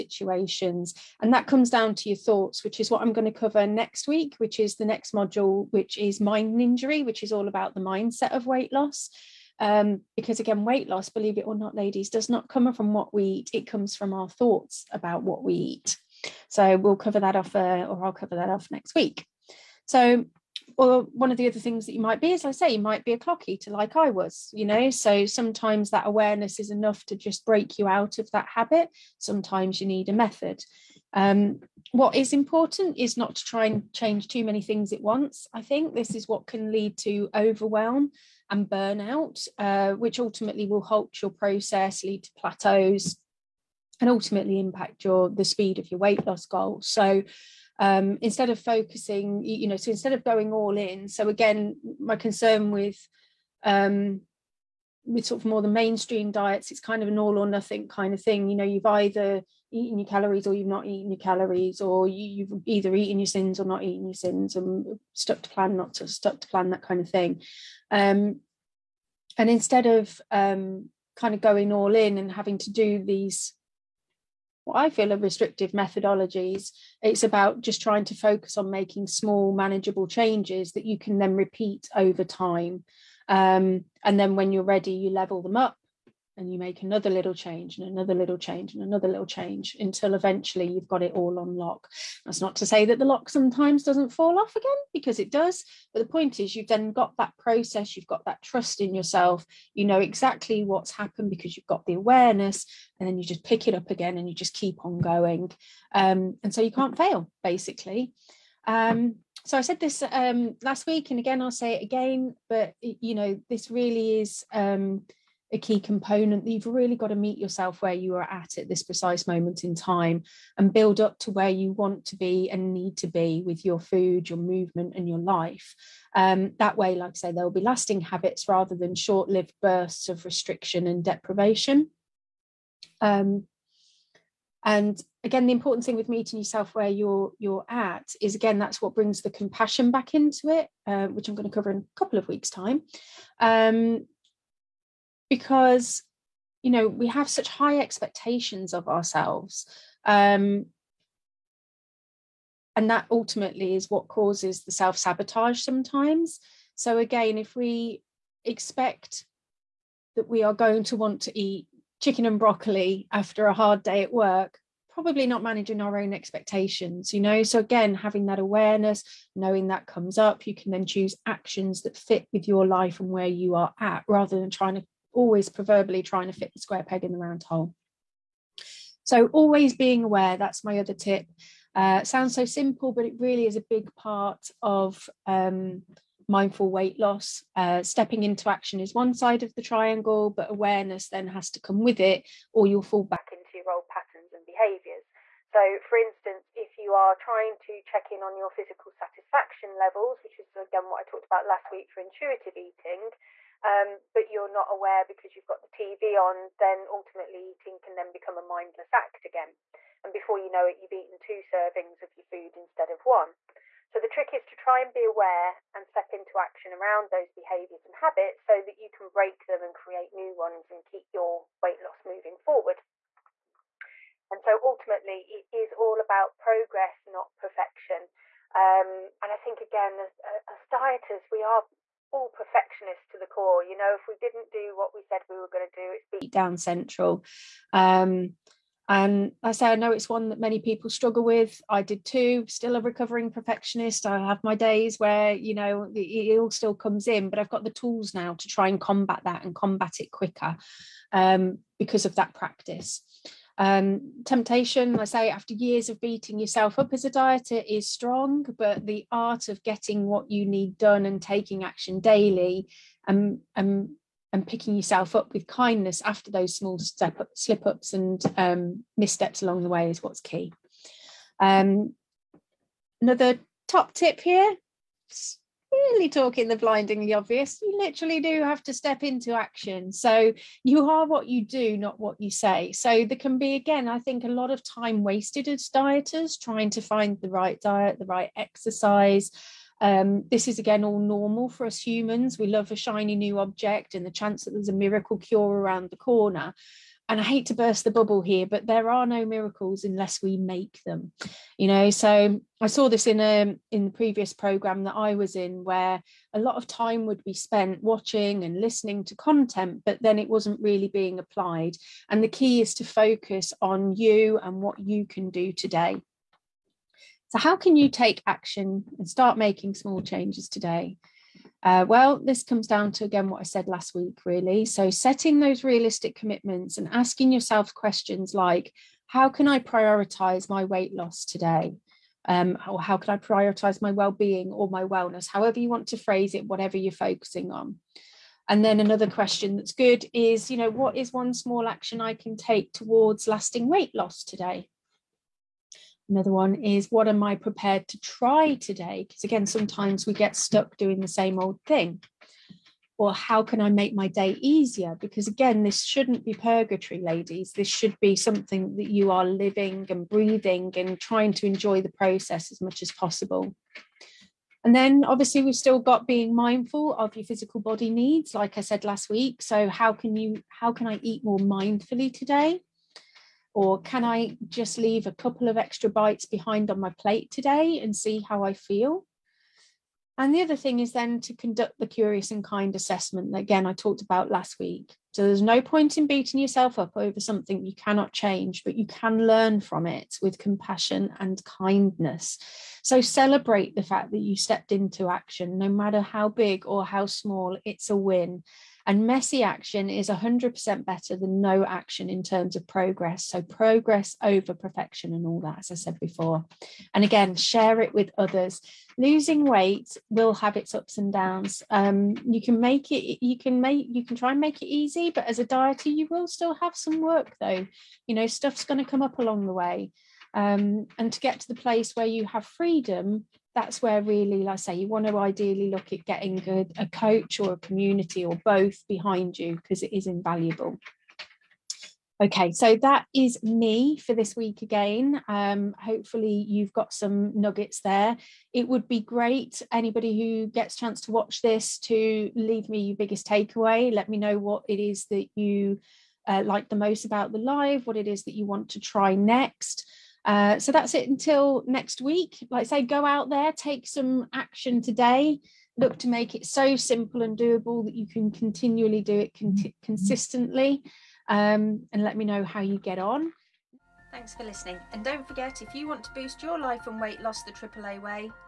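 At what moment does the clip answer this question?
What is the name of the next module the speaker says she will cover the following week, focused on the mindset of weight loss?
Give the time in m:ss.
0:06.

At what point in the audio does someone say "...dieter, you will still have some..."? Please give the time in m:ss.
6:55.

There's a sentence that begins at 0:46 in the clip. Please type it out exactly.
So um, instead of focusing, you know, so instead of going all in.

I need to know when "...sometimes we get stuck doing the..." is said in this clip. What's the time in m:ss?
5:49.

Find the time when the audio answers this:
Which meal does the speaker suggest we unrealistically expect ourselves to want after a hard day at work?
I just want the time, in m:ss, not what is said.
2:42.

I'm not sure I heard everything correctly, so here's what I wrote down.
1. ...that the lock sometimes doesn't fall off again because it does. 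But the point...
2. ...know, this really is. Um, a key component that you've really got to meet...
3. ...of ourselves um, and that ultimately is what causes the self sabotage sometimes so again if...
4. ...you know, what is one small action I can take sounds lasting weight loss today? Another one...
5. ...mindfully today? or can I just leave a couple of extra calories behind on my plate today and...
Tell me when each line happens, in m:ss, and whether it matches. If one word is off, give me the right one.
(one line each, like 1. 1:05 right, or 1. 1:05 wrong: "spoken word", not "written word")
1. 1:32 right
2. 1:53 right
3. 2:28 right
4. 5:40 wrong: "towards", not "sounds"
5. 6:11 wrong: "bites", not "calories".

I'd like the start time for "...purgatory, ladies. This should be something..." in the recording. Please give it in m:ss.
5:56.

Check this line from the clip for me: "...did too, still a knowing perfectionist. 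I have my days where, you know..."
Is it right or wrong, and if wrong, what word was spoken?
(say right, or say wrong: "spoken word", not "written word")
wrong: "recovering", not "knowing".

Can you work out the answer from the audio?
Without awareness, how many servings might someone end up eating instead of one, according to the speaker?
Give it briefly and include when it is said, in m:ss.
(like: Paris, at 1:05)
2, at 3:31.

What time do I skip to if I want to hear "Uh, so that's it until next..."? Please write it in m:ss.
7:30.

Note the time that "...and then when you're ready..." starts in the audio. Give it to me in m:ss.
1:24.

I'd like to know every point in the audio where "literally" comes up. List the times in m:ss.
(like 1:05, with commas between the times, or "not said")
4:37.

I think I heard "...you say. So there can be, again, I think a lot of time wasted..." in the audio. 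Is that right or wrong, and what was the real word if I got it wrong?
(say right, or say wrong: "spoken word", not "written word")
right.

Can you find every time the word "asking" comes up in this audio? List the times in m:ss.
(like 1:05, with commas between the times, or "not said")
5:26.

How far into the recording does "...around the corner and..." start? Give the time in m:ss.
4:55.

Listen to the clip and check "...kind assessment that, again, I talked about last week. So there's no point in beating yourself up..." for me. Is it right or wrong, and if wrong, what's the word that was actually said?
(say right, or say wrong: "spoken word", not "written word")
right.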